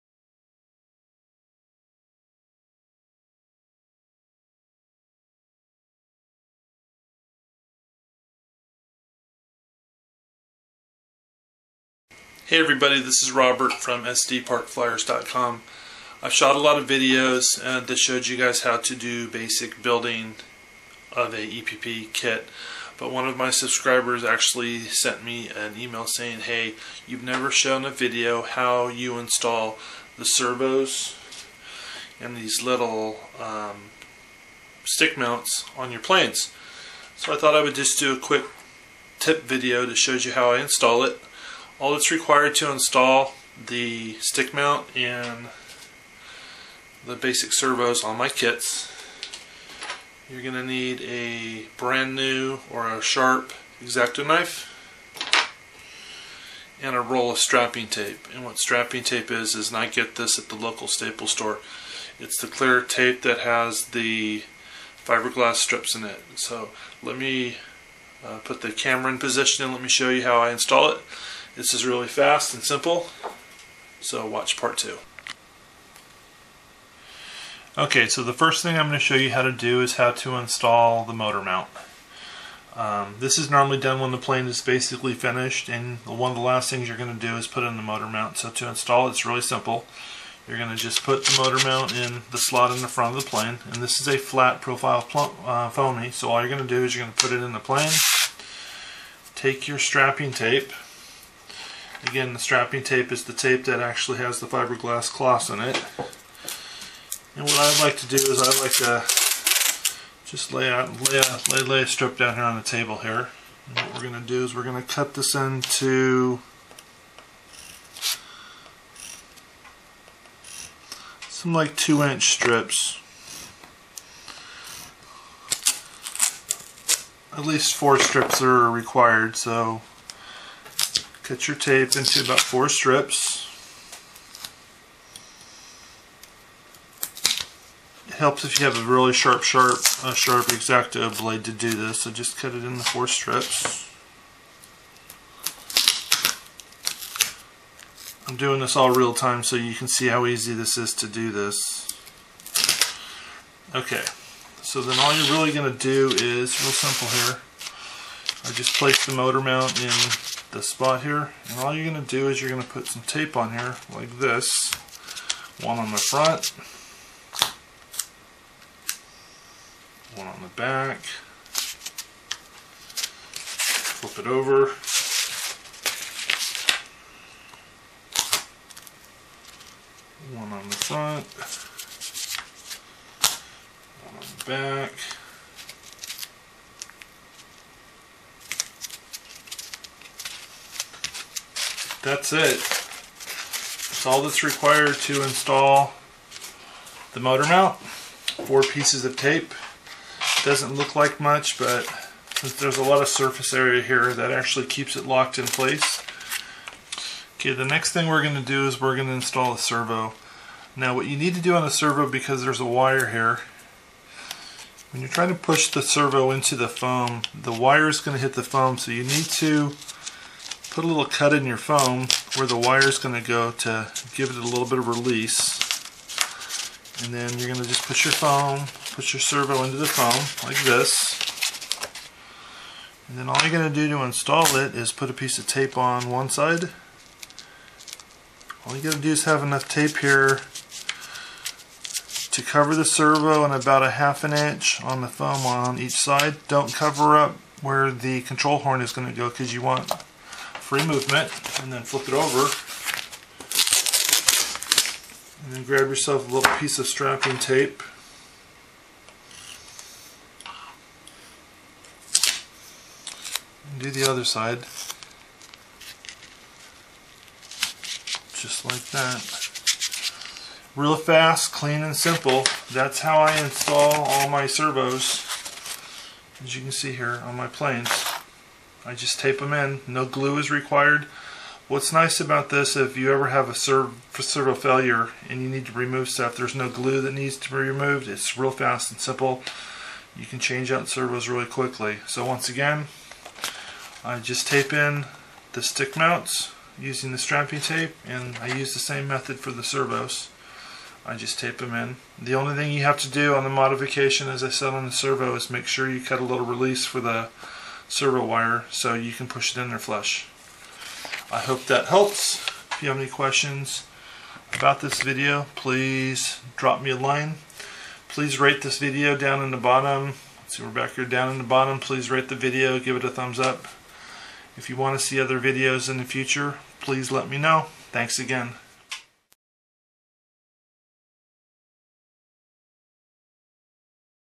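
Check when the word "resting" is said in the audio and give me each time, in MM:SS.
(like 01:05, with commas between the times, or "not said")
not said.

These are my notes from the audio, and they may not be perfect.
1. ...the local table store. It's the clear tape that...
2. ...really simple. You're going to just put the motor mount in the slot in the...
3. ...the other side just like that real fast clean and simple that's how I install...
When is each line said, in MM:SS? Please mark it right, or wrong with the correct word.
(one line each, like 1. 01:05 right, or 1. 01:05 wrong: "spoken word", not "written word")
1. 01:00 wrong: "staple", not "table"
2. 01:29 right
3. 04:23 right.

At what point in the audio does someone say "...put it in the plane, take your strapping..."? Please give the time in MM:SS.
01:37.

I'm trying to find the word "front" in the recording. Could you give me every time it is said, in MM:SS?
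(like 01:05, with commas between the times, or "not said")
01:32, 02:45, 03:00.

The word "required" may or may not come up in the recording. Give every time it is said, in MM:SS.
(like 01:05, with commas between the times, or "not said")
00:42, 02:08, 03:14, 04:40.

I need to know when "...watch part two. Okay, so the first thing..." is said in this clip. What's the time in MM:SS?
01:14.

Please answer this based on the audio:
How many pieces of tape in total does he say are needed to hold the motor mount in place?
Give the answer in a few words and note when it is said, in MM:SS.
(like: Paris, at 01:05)
4, at 03:17.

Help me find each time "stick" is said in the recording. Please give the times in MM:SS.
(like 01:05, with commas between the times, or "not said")
00:34, 00:44, 04:55.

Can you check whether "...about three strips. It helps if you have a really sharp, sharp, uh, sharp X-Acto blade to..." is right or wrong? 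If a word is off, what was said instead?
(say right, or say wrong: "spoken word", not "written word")
wrong: "four", not "three".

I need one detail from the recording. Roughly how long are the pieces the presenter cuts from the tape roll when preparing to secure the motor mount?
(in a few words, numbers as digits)
2 inches.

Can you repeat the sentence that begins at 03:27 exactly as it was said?
Okay, the next thing we're going to do is we're going to install a servo.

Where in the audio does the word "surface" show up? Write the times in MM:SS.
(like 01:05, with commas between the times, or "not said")
03:23.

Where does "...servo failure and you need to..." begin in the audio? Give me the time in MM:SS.
04:44.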